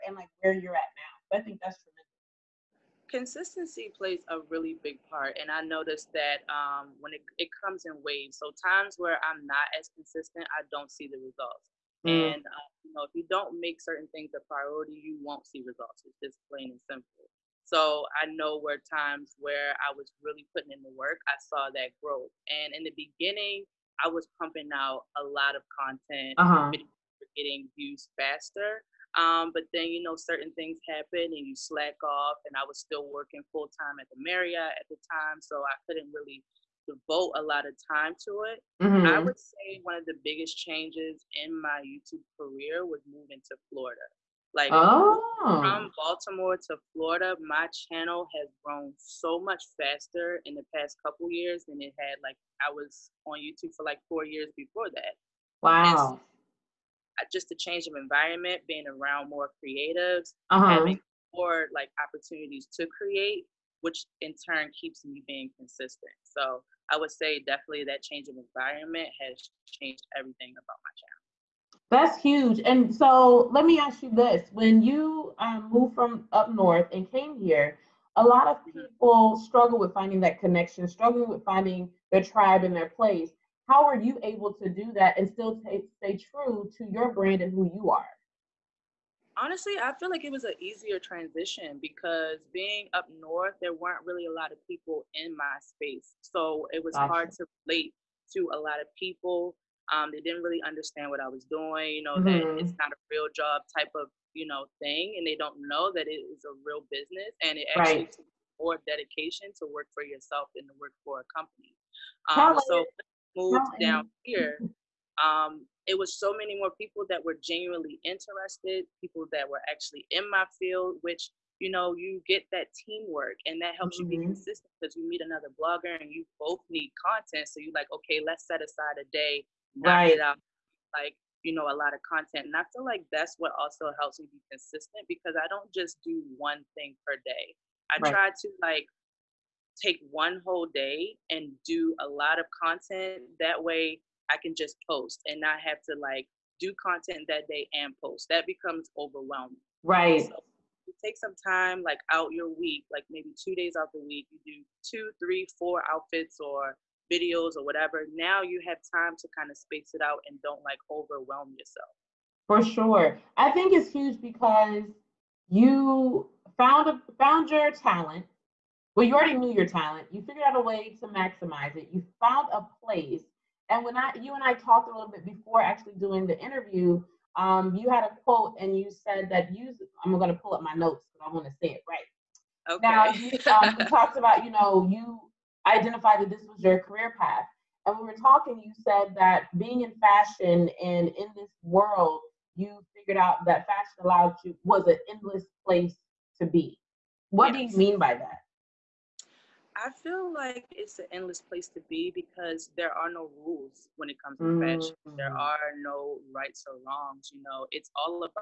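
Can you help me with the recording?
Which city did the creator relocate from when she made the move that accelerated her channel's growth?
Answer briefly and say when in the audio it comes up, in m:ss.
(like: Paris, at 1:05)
Baltimore, at 0:45.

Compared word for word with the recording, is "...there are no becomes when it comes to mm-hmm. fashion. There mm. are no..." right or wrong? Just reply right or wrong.
wrong.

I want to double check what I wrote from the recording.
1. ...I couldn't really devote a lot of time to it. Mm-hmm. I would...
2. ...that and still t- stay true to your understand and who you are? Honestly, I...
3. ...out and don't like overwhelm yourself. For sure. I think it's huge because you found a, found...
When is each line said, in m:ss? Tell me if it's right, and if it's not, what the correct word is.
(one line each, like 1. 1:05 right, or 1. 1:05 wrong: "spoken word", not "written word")
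1. 0:35 right
2. 1:24 wrong: "brand", not "understand"
3. 2:40 right.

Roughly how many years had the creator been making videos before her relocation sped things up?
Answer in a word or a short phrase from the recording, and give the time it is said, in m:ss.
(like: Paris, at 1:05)
4, at 0:54.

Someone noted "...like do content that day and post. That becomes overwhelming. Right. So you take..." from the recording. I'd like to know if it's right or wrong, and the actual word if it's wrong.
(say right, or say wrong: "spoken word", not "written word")
right.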